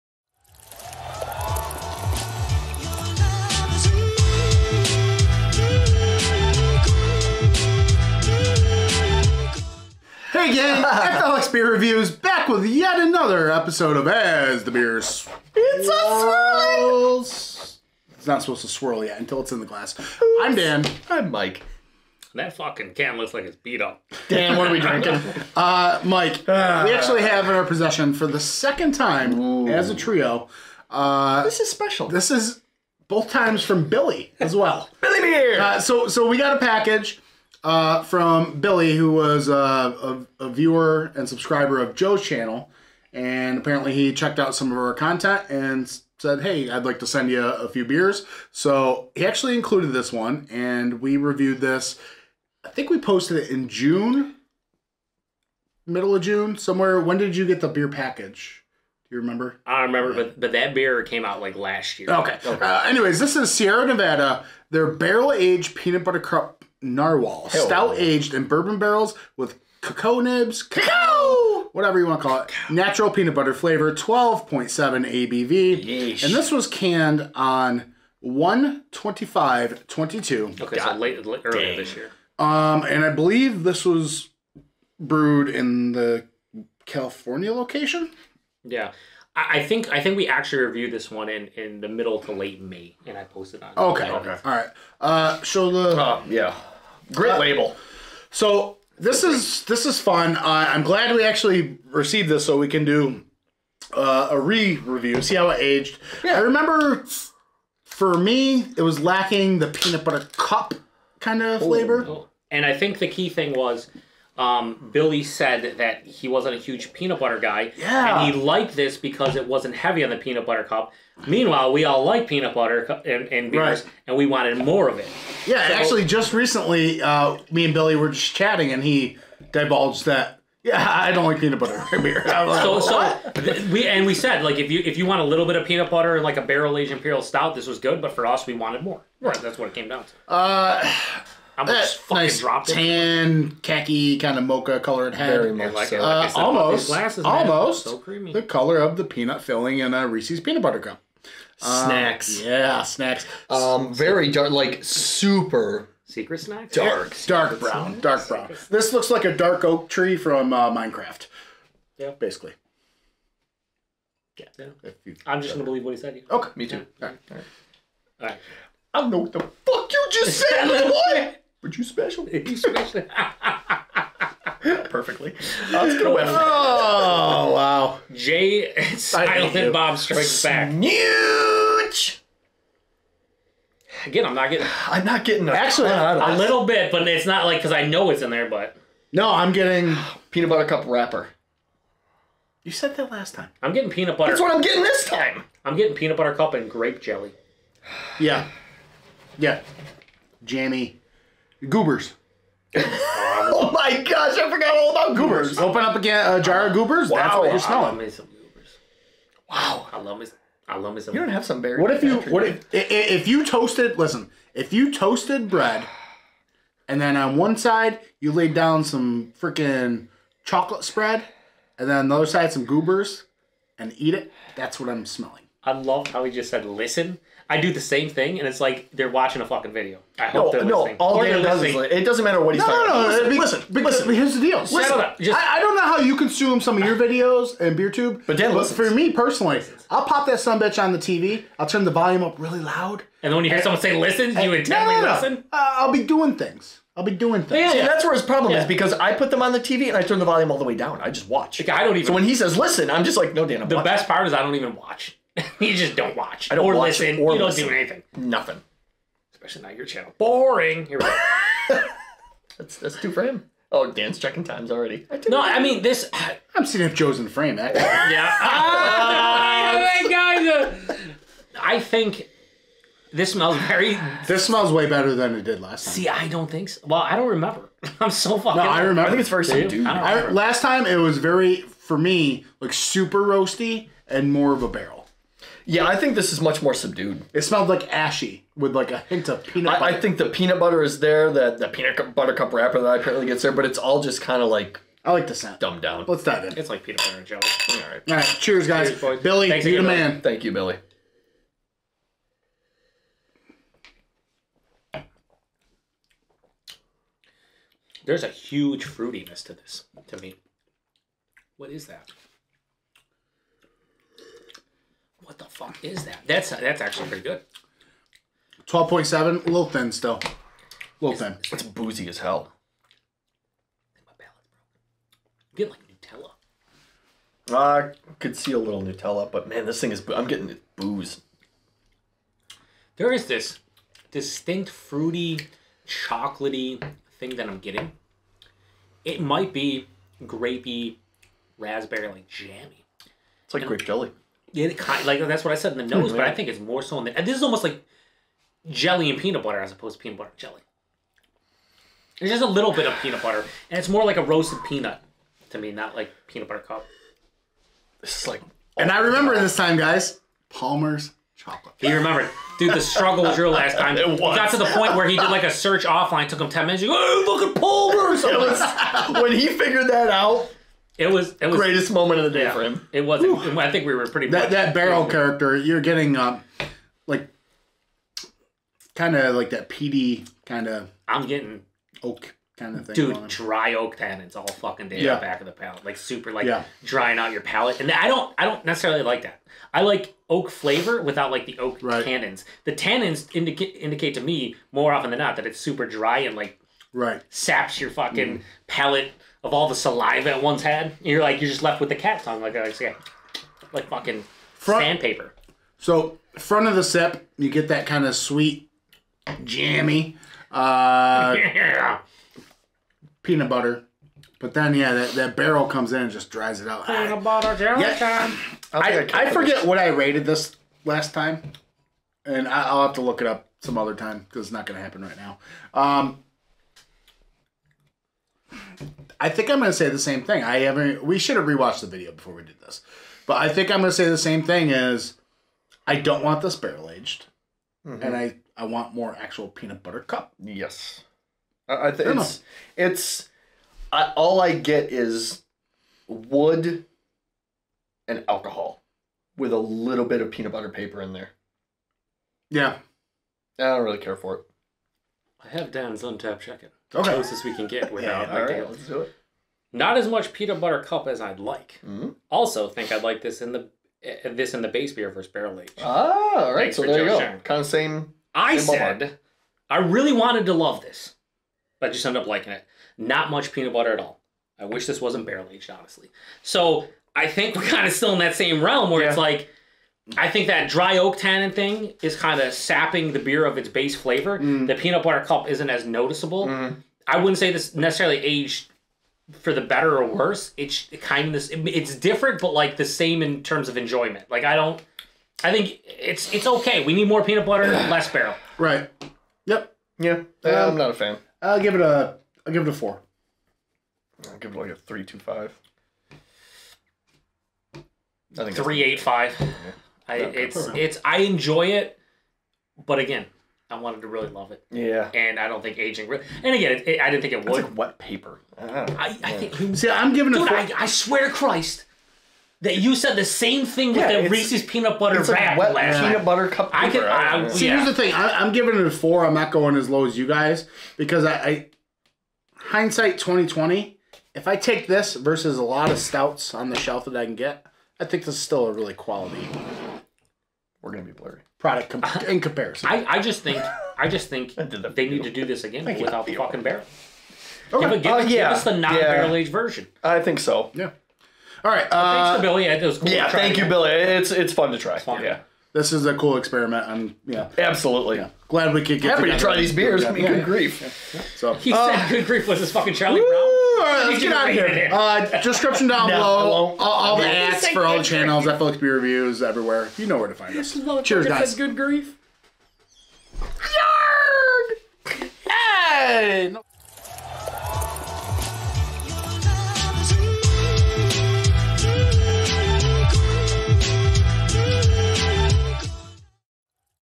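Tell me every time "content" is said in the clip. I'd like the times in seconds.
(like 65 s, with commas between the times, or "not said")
44 s.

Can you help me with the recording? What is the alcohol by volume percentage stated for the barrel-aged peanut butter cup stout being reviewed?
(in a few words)
12.7.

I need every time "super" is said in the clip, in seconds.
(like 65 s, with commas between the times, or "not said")
154 s, 282 s, 385 s, 395 s.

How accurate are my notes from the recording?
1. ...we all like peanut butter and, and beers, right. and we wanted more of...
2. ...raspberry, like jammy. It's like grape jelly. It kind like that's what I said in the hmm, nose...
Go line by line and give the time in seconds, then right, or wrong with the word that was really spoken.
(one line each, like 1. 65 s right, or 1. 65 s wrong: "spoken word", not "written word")
1. 121 s right
2. 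341 s right.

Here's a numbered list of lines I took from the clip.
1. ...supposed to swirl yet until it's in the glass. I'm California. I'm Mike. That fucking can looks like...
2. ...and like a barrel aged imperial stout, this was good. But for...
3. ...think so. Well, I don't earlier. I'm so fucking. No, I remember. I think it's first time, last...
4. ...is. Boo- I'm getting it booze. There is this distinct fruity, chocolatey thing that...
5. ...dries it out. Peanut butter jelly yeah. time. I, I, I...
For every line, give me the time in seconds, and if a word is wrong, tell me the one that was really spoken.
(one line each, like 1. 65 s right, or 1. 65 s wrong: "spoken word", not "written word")
1. 18 s wrong: "Dan", not "California"
2. 136 s right
3. 276 s wrong: "remember", not "earlier"
4. 329 s right
5. 416 s right.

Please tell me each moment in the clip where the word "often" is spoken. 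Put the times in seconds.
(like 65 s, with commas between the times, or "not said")
394 s.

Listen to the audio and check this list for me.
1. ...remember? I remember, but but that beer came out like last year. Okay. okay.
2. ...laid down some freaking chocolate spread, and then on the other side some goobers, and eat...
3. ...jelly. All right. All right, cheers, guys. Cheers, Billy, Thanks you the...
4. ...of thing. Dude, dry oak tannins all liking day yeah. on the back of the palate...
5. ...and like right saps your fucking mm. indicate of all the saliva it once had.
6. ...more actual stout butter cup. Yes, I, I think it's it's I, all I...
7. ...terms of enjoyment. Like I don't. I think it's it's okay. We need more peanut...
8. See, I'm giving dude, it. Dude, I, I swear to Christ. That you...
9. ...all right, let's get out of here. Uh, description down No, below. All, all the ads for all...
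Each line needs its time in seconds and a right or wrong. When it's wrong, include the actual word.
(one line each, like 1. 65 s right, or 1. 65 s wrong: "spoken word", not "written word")
1. 59 s right
2. 218 s right
3. 297 s right
4. 382 s wrong: "fucking", not "liking"
5. 396 s wrong: "palate", not "indicate"
6. 438 s wrong: "peanut", not "stout"
7. 493 s right
8. 519 s right
9. 563 s right.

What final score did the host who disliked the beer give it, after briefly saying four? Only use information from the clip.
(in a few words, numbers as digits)
3.25.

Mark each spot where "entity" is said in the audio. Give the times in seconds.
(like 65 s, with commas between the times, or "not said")
not said.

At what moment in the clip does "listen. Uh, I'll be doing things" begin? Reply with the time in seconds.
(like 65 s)
245 s.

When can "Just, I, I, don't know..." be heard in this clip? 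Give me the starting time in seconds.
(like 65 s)
235 s.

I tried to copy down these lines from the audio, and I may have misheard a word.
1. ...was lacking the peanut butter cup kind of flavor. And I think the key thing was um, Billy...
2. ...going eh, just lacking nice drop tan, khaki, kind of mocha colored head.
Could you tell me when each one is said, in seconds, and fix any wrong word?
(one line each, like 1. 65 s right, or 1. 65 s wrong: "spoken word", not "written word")
1. 108 s right
2. 141 s wrong: "fucking", not "lacking".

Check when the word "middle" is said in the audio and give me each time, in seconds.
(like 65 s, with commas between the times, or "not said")
55 s, 91 s.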